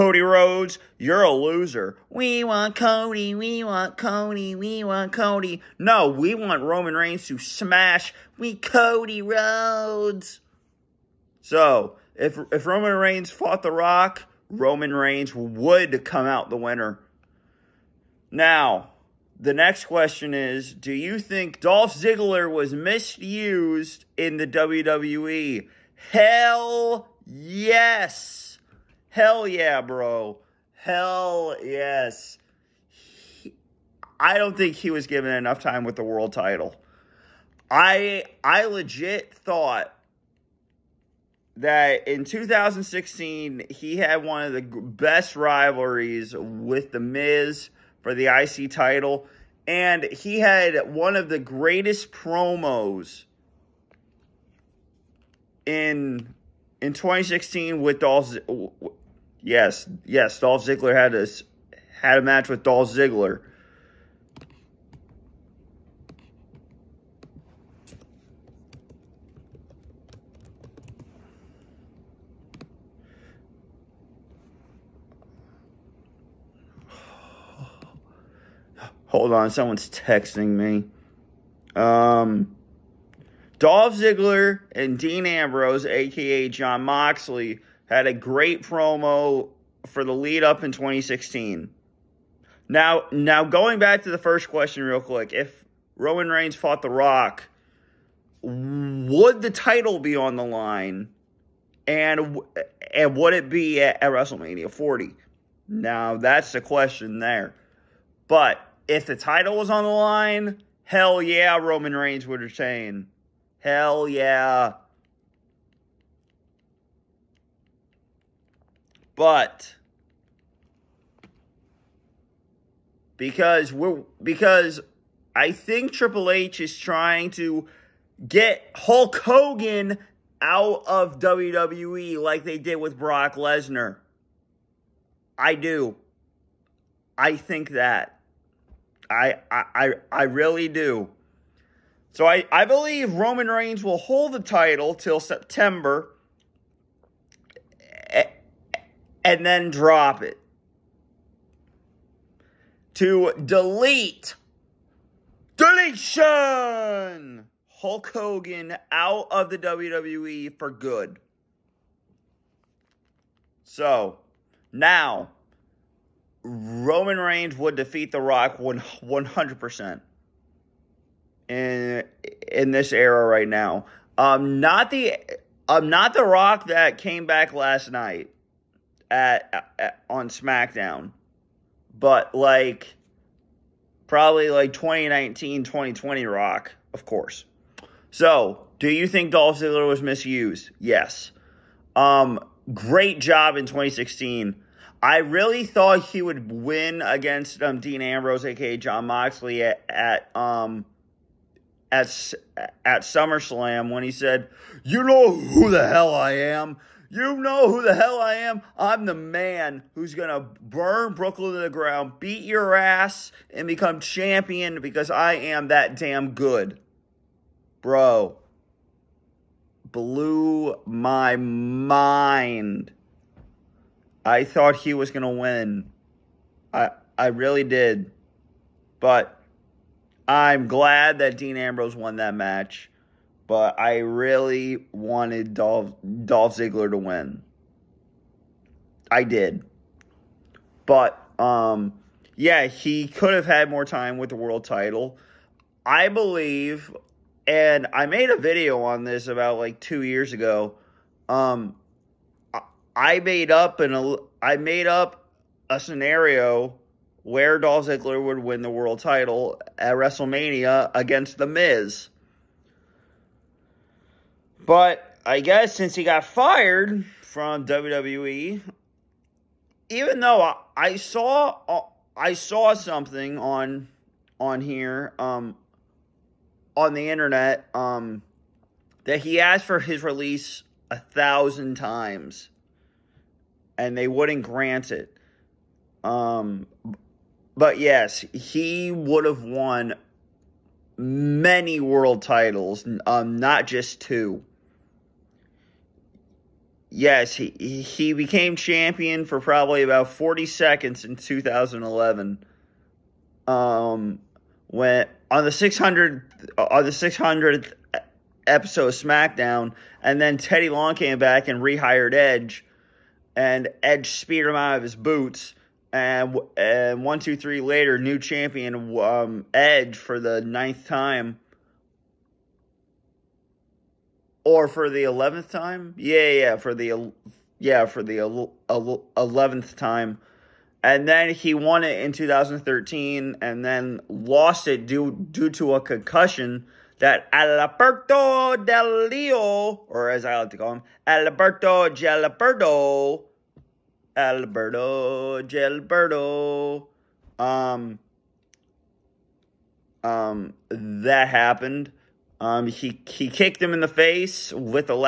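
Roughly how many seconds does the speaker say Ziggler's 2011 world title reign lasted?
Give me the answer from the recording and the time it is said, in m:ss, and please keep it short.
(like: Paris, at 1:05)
40 seconds, at 5:00.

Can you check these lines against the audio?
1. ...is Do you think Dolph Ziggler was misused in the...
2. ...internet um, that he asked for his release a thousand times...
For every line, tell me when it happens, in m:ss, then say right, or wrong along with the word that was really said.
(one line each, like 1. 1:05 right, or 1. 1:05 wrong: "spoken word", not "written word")
1. 0:20 right
2. 4:37 right.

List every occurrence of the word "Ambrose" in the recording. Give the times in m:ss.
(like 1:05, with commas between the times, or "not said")
1:25, 3:18, 3:51.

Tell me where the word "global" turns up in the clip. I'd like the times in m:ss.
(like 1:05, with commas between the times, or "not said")
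not said.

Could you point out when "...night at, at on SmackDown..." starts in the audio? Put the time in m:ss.
2:57.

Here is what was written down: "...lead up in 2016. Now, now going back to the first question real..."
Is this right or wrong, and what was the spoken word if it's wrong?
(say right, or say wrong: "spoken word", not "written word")
right.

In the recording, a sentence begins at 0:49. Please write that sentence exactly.
And he had one of the greatest promos in in 2016 with Dolph.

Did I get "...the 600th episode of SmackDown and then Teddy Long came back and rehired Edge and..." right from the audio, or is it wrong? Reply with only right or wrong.
right.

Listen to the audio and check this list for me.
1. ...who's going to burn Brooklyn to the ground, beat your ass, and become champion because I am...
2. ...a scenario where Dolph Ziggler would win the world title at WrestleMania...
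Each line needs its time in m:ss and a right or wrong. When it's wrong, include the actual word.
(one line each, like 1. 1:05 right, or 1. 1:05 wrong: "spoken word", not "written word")
1. 3:29 right
2. 4:15 right.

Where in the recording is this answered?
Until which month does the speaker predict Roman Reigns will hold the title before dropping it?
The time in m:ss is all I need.
2:25.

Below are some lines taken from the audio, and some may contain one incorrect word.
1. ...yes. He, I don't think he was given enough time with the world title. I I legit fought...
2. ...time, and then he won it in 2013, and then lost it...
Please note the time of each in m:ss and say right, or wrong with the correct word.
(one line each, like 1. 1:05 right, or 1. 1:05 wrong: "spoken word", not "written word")
1. 0:31 wrong: "thought", not "fought"
2. 5:29 right.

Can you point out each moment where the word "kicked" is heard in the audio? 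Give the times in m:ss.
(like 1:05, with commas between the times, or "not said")
5:53.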